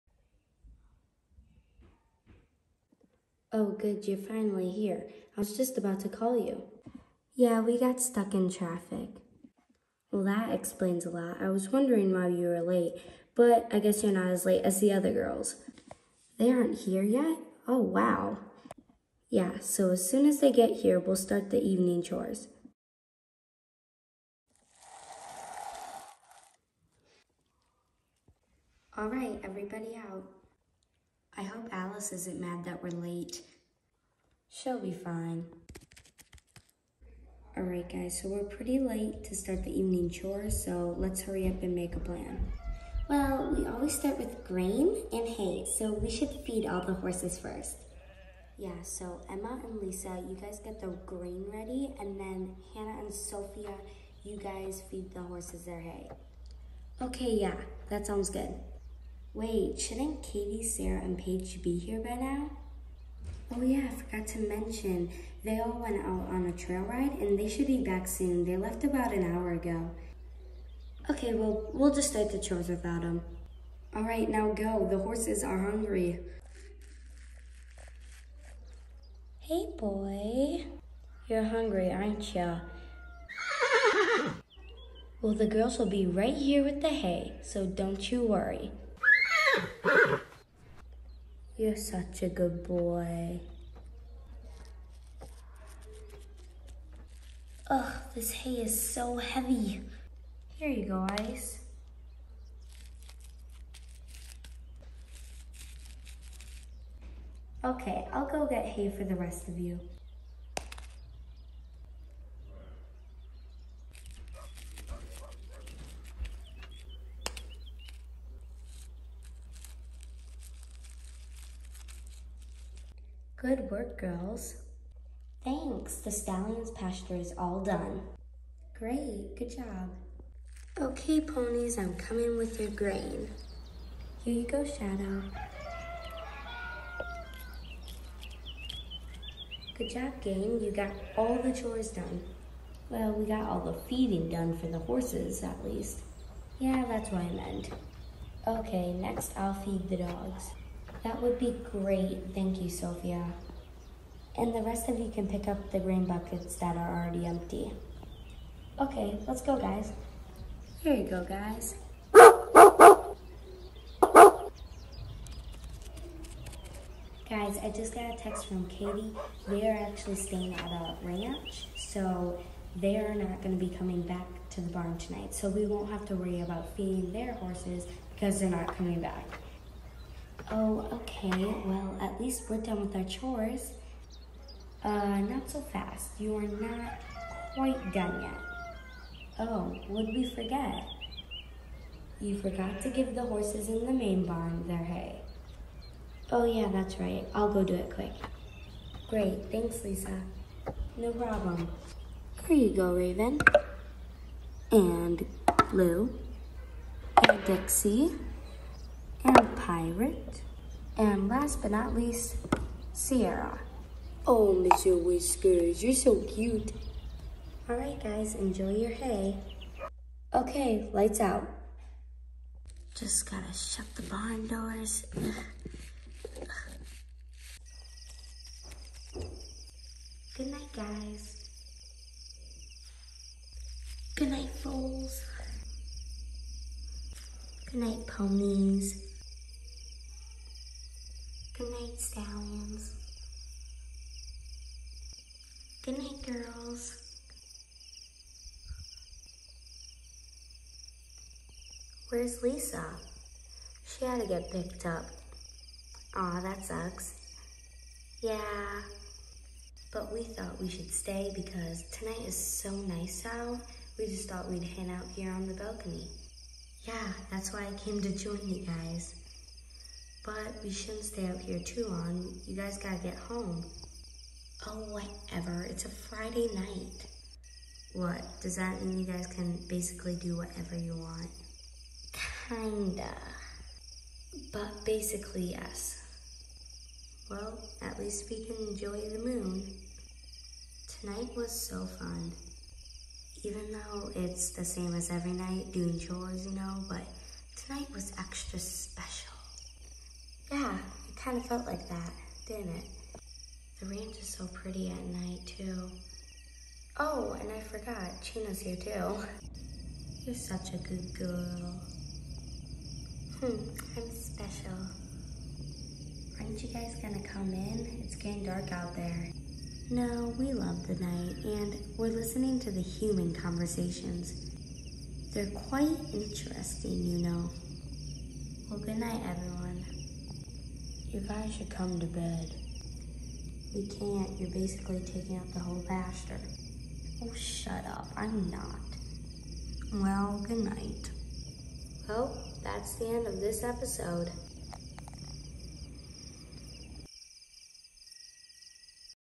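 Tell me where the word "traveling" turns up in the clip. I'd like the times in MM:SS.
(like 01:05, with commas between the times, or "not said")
not said.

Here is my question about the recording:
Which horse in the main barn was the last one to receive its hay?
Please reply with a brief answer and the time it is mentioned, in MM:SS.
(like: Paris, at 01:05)
Sierra, at 03:32.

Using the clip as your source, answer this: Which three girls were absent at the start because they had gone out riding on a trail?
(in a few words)
Katie, Sarah, and Paige.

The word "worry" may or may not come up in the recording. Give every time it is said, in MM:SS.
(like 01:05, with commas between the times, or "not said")
01:28, 02:56.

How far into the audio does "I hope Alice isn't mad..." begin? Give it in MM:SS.
00:31.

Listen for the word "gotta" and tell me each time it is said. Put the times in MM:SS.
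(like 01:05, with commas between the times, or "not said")
03:43, 04:32.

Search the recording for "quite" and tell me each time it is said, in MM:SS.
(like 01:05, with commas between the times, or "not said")
03:07, 05:25.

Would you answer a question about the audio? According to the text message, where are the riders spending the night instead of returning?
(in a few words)
A ranch.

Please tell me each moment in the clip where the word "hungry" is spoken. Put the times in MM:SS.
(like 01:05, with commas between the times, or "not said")
01:15, 01:21.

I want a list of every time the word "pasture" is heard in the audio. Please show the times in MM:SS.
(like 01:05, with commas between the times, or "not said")
02:06, 05:35.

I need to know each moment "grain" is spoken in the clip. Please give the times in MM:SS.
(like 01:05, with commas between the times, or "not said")
00:44, 00:51, 02:12, 02:35.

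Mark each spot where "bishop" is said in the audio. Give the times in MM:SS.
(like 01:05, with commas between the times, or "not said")
not said.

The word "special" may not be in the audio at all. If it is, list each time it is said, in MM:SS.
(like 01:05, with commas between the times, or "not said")
04:58, 05:14.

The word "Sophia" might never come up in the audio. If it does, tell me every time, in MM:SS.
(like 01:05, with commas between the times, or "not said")
00:53, 02:32.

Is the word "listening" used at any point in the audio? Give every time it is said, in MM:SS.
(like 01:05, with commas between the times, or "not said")
05:22.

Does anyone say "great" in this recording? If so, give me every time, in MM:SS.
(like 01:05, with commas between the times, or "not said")
02:08, 02:31, 03:19.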